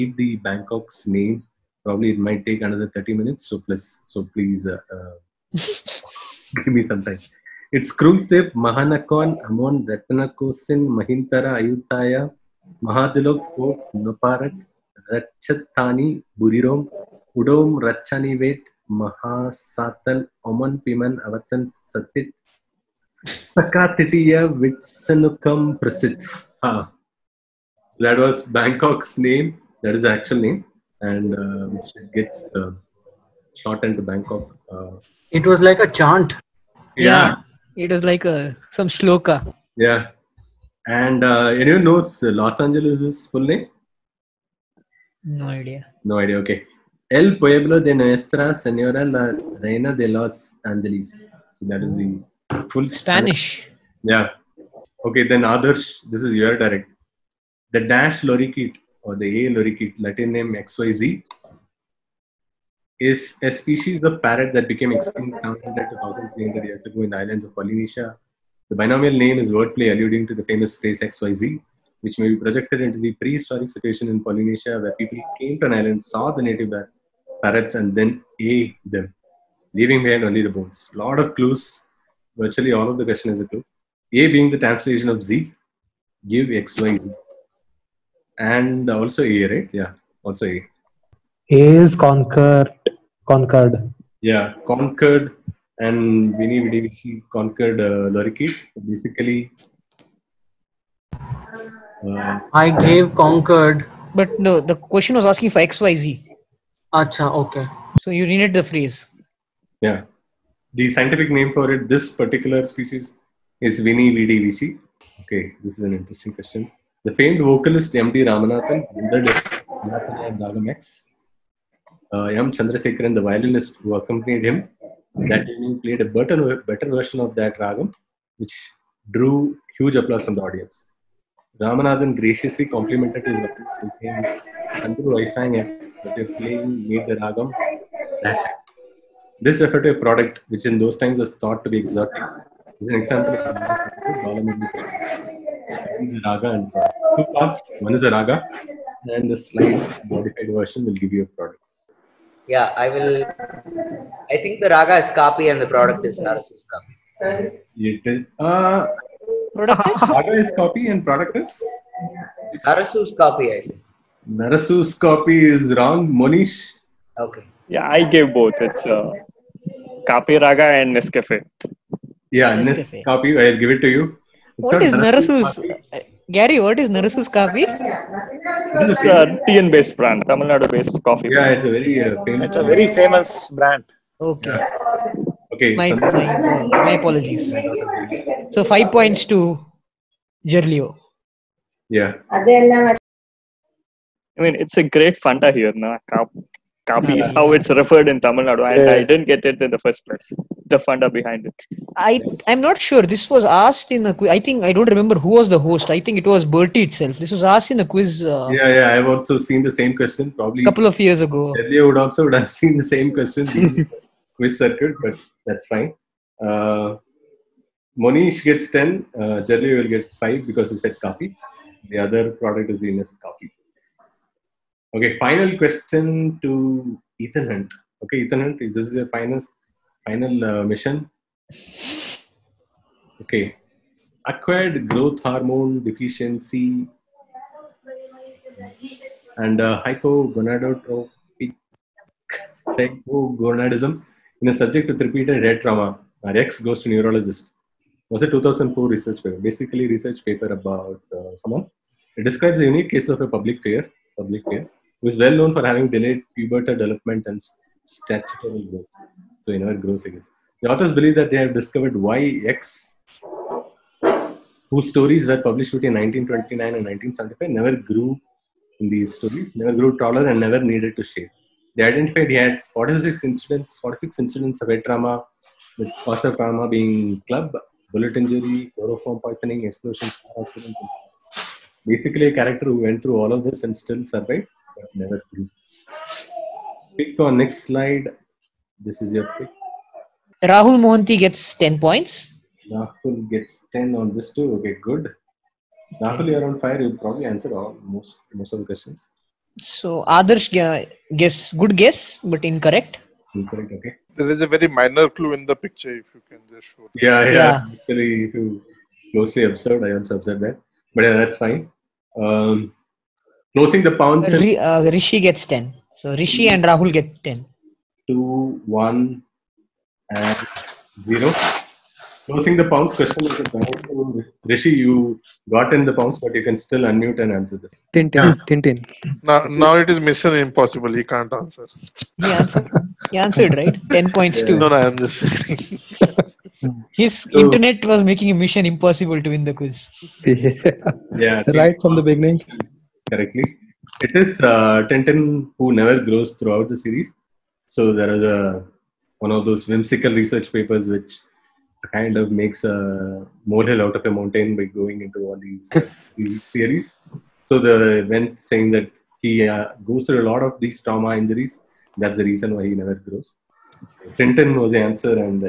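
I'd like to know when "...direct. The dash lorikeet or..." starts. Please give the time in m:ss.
0:56.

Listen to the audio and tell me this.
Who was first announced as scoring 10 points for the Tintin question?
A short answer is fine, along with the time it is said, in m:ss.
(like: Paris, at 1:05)
Rahul Mohanty, at 4:50.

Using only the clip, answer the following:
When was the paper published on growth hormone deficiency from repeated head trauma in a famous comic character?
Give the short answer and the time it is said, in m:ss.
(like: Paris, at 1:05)
2004, at 4:08.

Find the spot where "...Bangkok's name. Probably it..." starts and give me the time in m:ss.
0:00.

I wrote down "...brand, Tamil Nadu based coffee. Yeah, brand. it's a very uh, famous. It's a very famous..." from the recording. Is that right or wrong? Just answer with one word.
right.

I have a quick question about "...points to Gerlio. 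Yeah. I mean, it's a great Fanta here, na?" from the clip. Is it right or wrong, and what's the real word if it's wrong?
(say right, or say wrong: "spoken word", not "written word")
right.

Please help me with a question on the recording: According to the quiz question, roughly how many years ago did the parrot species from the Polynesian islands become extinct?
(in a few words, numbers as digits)
700 to 1,300 years.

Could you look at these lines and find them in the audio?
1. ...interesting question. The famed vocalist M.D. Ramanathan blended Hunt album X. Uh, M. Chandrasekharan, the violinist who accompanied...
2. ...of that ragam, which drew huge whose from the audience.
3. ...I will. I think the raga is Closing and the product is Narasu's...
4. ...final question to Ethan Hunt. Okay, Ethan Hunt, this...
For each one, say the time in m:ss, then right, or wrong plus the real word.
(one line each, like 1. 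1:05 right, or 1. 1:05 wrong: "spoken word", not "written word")
1. 1:55 wrong: "Ramanathan", not "Hunt"
2. 2:07 wrong: "applause", not "whose"
3. 2:32 wrong: "Kapi", not "Closing"
4. 3:45 right.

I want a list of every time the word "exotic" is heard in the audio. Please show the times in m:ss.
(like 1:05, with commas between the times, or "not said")
2:21.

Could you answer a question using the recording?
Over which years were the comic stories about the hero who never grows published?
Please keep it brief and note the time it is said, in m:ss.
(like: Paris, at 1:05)
1929 and 1975, at 4:25.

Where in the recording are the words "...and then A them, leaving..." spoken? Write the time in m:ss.
1:17.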